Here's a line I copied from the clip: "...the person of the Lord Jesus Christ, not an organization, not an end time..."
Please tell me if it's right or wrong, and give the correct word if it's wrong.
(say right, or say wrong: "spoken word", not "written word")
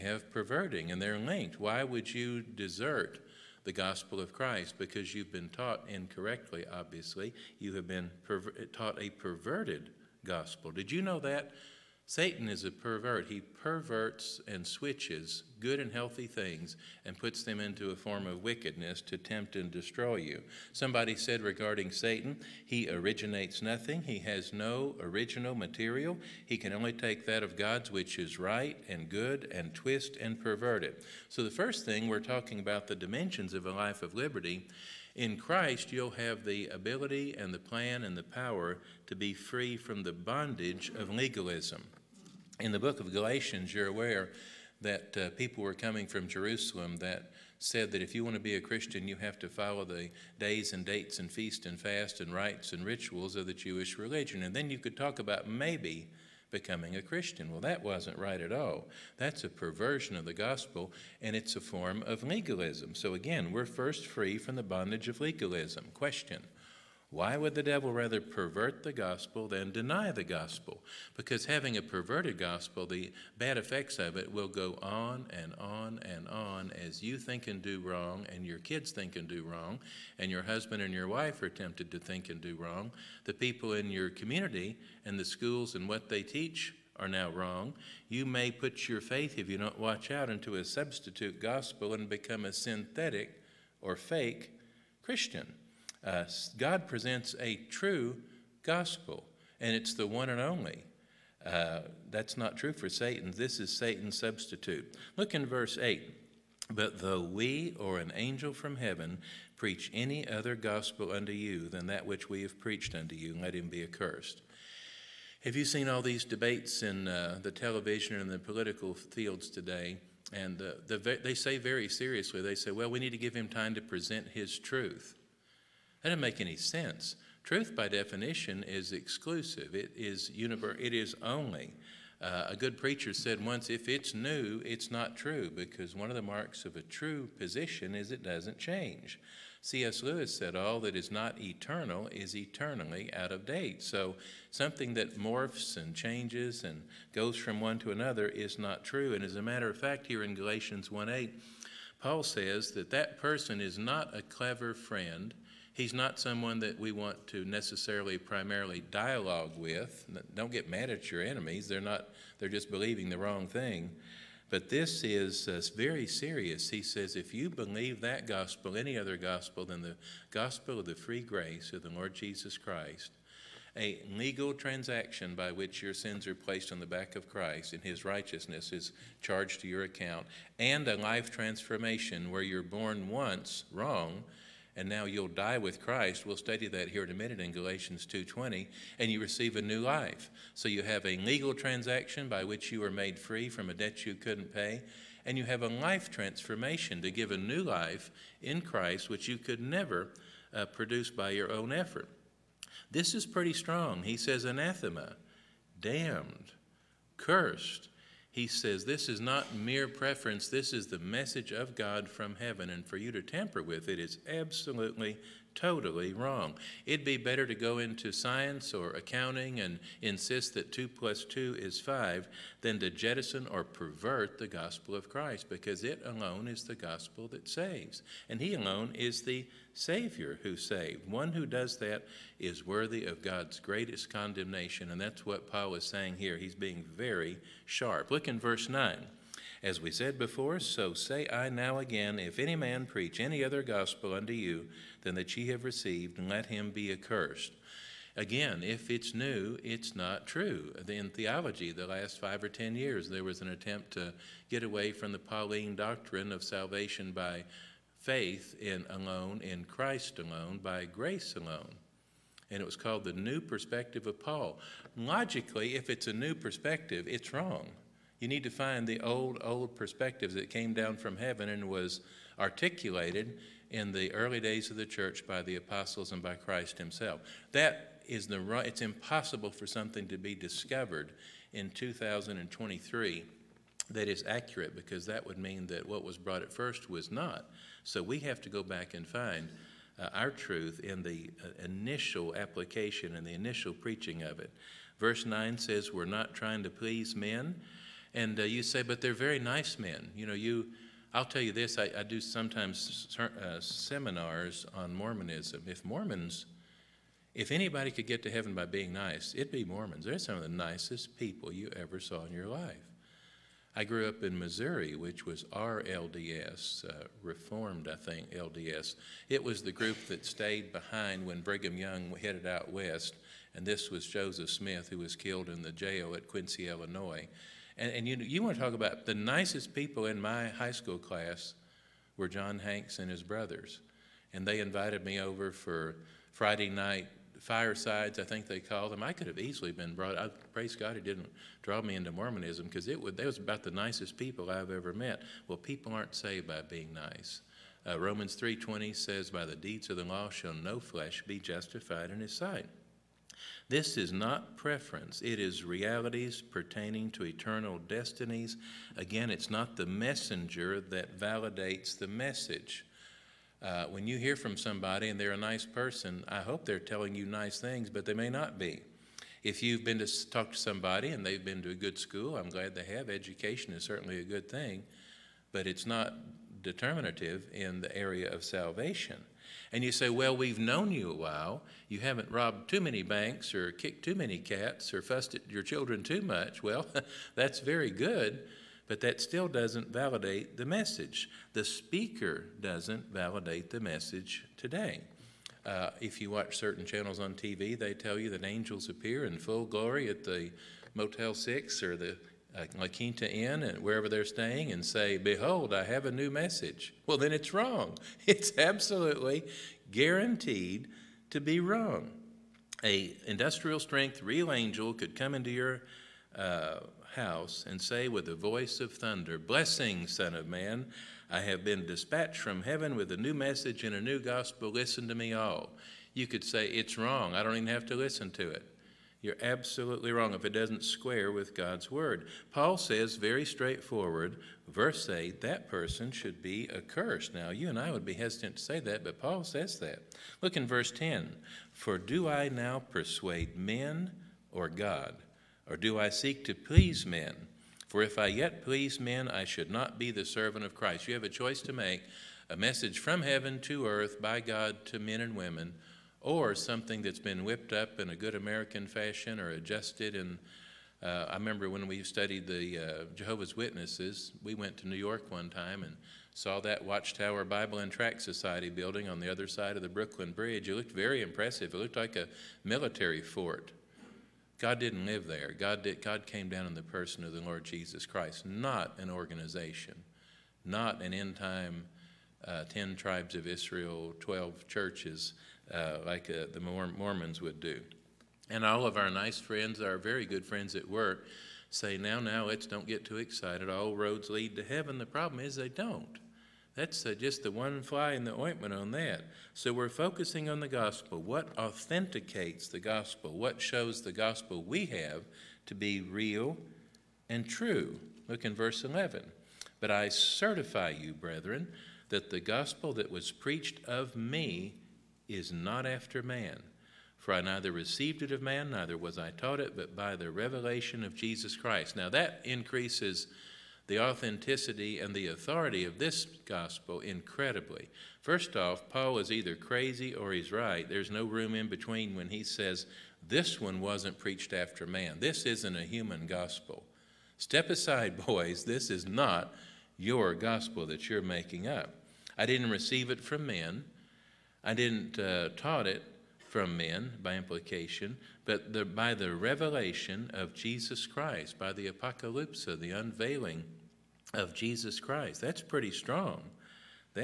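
right.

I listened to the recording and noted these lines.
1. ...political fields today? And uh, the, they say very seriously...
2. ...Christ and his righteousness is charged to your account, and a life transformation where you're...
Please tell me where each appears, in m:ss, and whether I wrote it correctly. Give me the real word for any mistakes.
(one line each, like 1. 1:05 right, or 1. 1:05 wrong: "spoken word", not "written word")
1. 1:58 right
2. 2:57 right.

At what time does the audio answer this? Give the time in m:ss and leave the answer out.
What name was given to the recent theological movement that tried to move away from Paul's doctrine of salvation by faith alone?
4:23.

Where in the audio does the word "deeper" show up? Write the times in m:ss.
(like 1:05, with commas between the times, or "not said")
not said.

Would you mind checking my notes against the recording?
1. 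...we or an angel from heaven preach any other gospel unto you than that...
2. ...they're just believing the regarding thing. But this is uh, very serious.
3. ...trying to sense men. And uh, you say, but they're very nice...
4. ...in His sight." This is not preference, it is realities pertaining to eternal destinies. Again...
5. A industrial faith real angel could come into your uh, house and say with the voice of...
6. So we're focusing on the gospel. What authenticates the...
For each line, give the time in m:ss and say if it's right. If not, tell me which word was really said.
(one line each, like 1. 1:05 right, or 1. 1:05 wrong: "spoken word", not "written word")
1. 1:47 right
2. 2:42 wrong: "wrong", not "regarding"
3. 4:56 wrong: "please", not "sense"
4. 5:52 right
5. 6:52 wrong: "strength", not "faith"
6. 8:19 right.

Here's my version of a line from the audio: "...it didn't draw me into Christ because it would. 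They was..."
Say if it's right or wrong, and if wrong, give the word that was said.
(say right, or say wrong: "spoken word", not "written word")
wrong: "Mormonism", not "Christ".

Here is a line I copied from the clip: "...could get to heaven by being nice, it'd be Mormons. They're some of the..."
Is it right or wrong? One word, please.
right.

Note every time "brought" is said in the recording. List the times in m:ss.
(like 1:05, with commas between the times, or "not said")
4:46, 5:39.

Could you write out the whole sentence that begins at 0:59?
That's a perversion of the gospel, and it's a form of legalism.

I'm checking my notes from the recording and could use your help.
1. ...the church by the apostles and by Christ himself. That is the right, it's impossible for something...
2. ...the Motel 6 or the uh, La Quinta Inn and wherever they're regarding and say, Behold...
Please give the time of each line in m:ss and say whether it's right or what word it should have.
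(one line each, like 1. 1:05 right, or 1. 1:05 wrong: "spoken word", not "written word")
1. 4:34 right
2. 6:40 wrong: "staying", not "regarding".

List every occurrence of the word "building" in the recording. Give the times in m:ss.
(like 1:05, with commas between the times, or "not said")
7:48.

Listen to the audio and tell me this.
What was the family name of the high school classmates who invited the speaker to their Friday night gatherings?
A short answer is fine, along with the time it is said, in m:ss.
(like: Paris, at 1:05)
Hanks, at 5:32.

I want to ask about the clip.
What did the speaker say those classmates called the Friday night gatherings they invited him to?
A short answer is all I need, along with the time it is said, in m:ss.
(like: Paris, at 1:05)
firesides, at 5:37.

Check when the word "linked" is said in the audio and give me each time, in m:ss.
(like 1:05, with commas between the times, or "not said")
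0:01.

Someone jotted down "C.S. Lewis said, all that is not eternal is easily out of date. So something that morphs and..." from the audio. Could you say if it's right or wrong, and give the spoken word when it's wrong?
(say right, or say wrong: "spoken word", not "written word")
wrong: "eternally", not "easily".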